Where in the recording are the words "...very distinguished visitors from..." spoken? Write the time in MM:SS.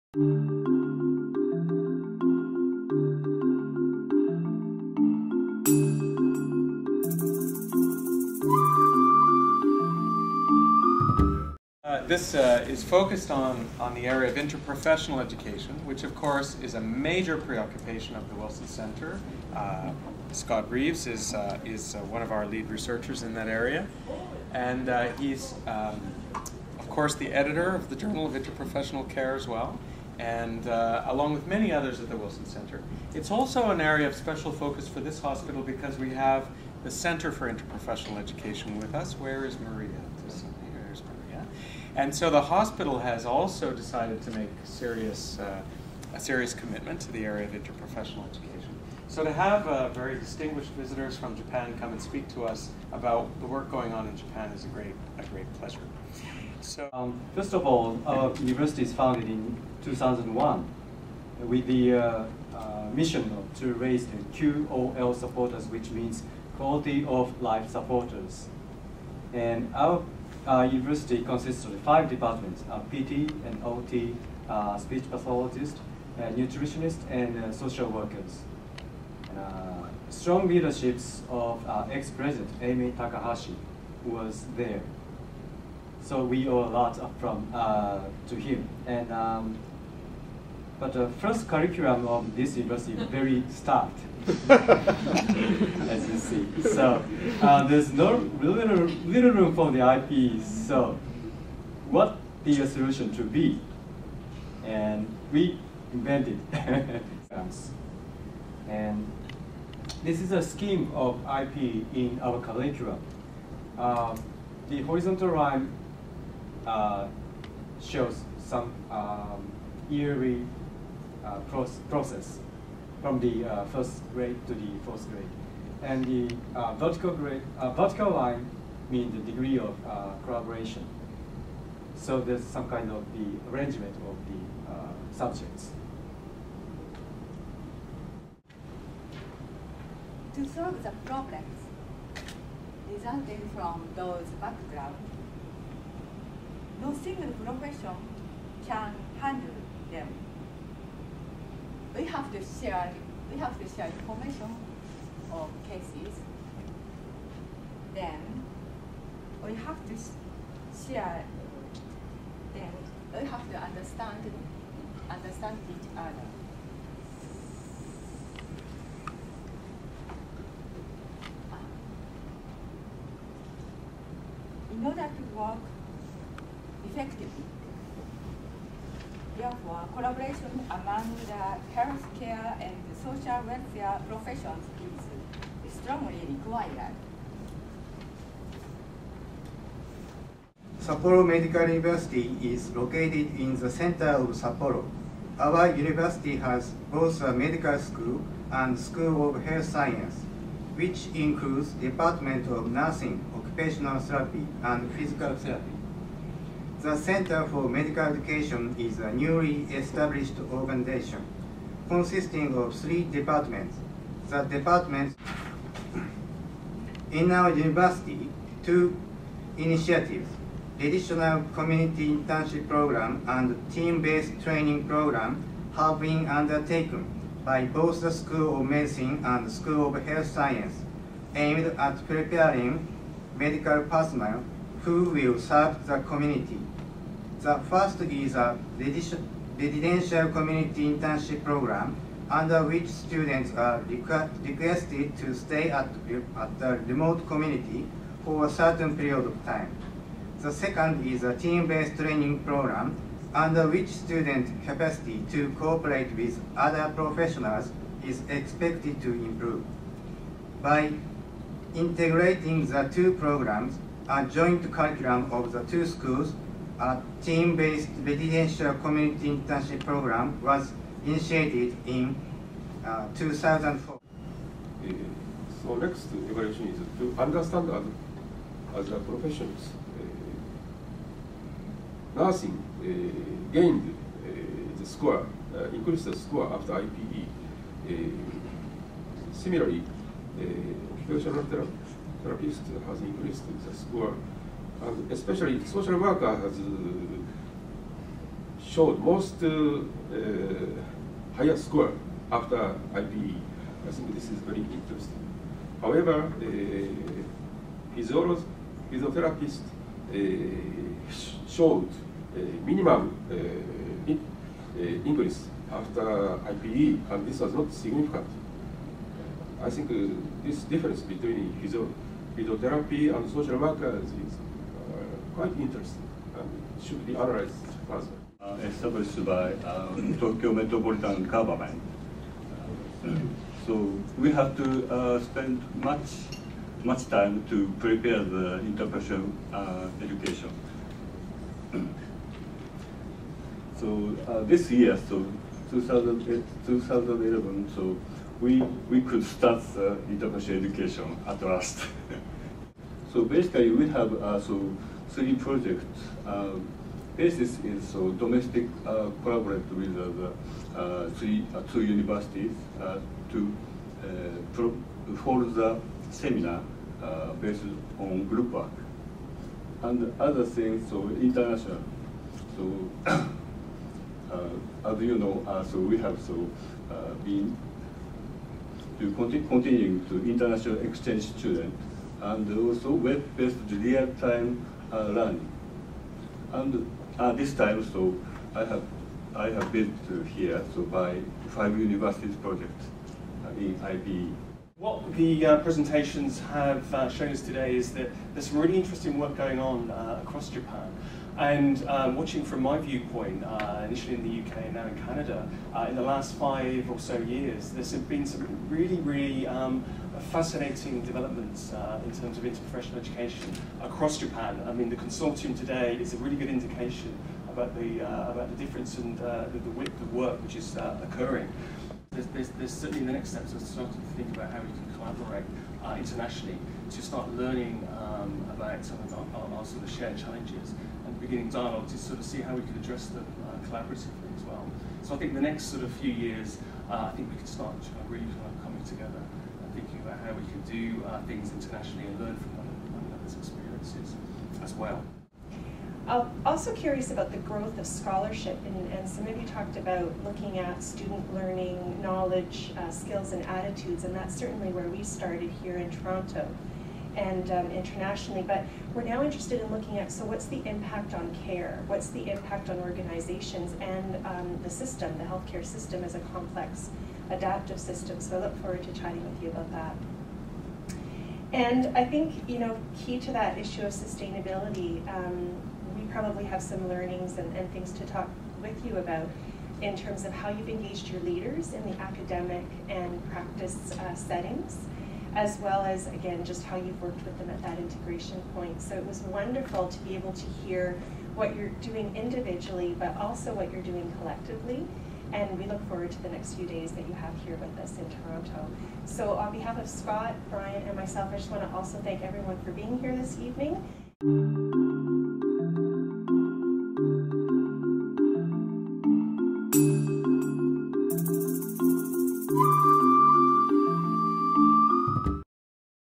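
00:49.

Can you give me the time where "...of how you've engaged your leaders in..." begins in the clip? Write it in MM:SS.
08:00.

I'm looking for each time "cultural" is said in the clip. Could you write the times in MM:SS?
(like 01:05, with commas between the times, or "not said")
not said.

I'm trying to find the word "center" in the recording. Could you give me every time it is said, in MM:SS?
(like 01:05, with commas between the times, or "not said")
00:18, 00:32, 00:36, 03:13, 03:26.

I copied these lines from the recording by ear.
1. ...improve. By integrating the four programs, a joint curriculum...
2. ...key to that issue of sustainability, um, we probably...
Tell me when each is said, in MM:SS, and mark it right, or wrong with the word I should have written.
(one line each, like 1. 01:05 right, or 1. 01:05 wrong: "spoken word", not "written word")
1. 04:19 wrong: "two", not "four"
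2. 07:52 right.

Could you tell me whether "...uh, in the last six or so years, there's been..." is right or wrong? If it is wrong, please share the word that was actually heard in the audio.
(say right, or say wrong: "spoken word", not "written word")
wrong: "five", not "six".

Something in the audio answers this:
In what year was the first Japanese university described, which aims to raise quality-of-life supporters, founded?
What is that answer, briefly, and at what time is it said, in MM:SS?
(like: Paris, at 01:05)
2001, at 00:59.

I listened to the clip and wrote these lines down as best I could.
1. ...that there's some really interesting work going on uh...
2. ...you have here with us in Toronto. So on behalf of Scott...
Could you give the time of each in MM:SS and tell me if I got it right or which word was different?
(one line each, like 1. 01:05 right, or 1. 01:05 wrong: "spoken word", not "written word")
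1. 06:37 right
2. 08:17 right.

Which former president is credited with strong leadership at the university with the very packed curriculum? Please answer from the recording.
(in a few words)
Amy Takahashi.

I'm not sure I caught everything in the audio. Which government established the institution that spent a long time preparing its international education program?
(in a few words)
Tokyo Metropolitan Government.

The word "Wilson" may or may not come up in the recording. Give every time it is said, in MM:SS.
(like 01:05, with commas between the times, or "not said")
00:18, 00:32.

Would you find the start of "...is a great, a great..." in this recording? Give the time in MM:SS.
00:54.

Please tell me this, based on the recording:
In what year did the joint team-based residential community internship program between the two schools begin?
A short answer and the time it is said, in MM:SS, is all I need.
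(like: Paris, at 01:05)
2004, at 04:33.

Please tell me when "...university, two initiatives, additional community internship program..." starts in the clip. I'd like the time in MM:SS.
03:37.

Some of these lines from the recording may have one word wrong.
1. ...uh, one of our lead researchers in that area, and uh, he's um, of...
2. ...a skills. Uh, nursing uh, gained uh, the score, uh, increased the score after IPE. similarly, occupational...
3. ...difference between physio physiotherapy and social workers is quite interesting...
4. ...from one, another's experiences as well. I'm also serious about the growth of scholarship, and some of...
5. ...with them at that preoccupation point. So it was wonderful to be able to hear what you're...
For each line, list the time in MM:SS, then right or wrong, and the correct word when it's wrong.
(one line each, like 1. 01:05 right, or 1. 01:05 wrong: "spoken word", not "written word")
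1. 00:21 right
2. 04:38 wrong: "professionals", not "skills"
3. 05:20 right
4. 07:22 wrong: "curious", not "serious"
5. 08:07 wrong: "integration", not "preoccupation".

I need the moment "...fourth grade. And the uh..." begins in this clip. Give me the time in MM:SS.
02:04.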